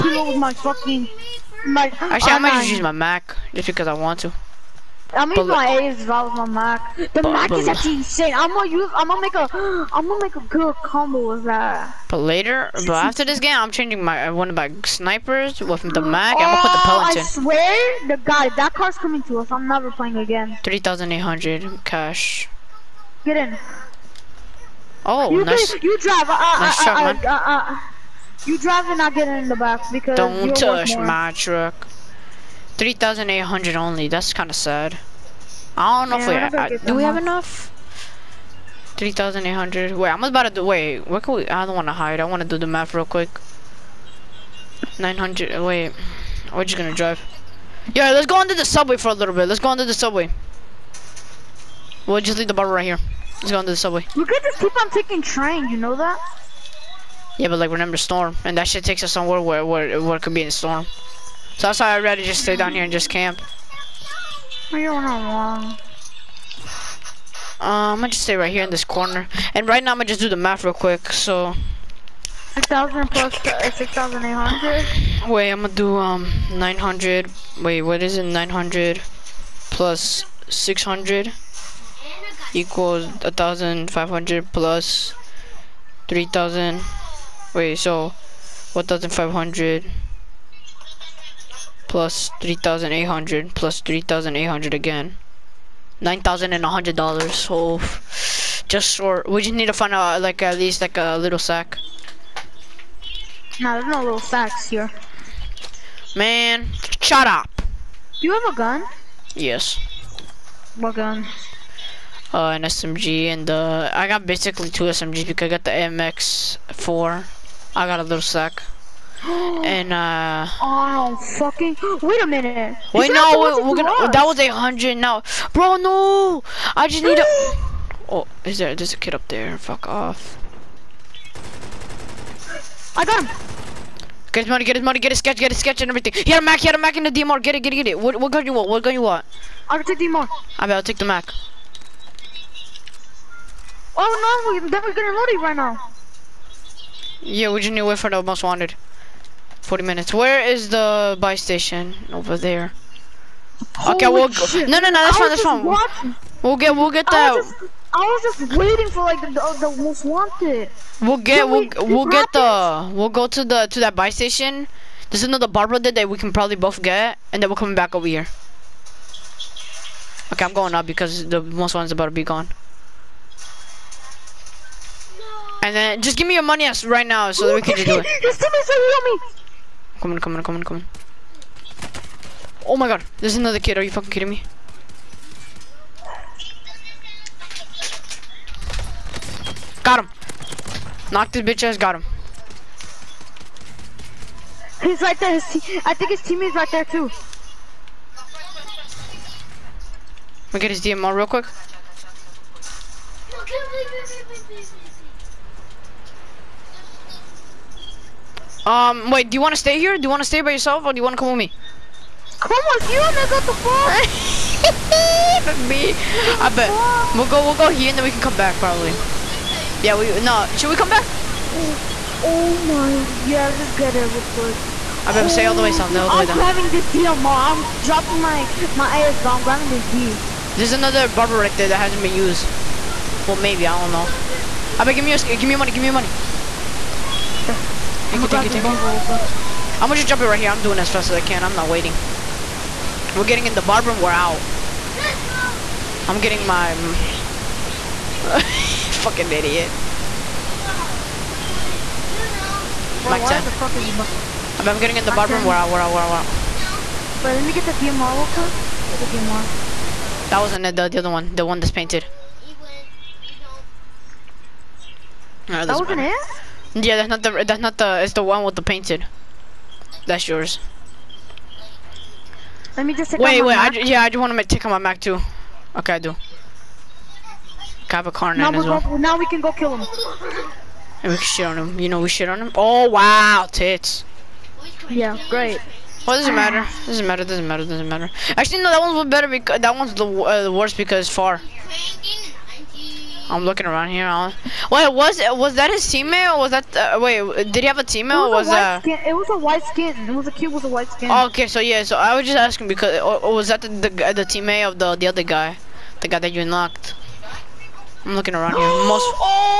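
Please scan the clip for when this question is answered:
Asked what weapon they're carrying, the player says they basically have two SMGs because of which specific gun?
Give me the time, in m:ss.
1:55.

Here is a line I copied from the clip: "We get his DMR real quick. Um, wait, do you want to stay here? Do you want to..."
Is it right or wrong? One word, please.
right.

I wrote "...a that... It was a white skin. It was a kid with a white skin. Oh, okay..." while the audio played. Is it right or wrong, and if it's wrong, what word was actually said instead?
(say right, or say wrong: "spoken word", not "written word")
right.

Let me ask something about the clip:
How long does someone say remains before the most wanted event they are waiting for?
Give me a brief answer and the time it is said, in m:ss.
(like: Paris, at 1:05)
40 minutes, at 2:29.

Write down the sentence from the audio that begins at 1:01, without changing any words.
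So that's why I'd rather just stay down here and just camp.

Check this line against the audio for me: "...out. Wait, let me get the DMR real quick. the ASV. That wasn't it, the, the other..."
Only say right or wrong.
wrong.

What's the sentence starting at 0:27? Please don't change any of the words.
Uh, uh, you drive and I get in the back because.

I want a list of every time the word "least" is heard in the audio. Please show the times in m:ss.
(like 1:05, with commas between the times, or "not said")
1:40.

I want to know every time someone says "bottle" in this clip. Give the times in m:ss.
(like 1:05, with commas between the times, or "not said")
0:52.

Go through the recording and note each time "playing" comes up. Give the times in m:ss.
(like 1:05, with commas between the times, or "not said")
0:19.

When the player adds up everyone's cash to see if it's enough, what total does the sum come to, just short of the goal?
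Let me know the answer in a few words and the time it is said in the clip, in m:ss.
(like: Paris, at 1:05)
$9,100, at 1:36.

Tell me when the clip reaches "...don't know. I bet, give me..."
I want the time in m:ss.
3:53.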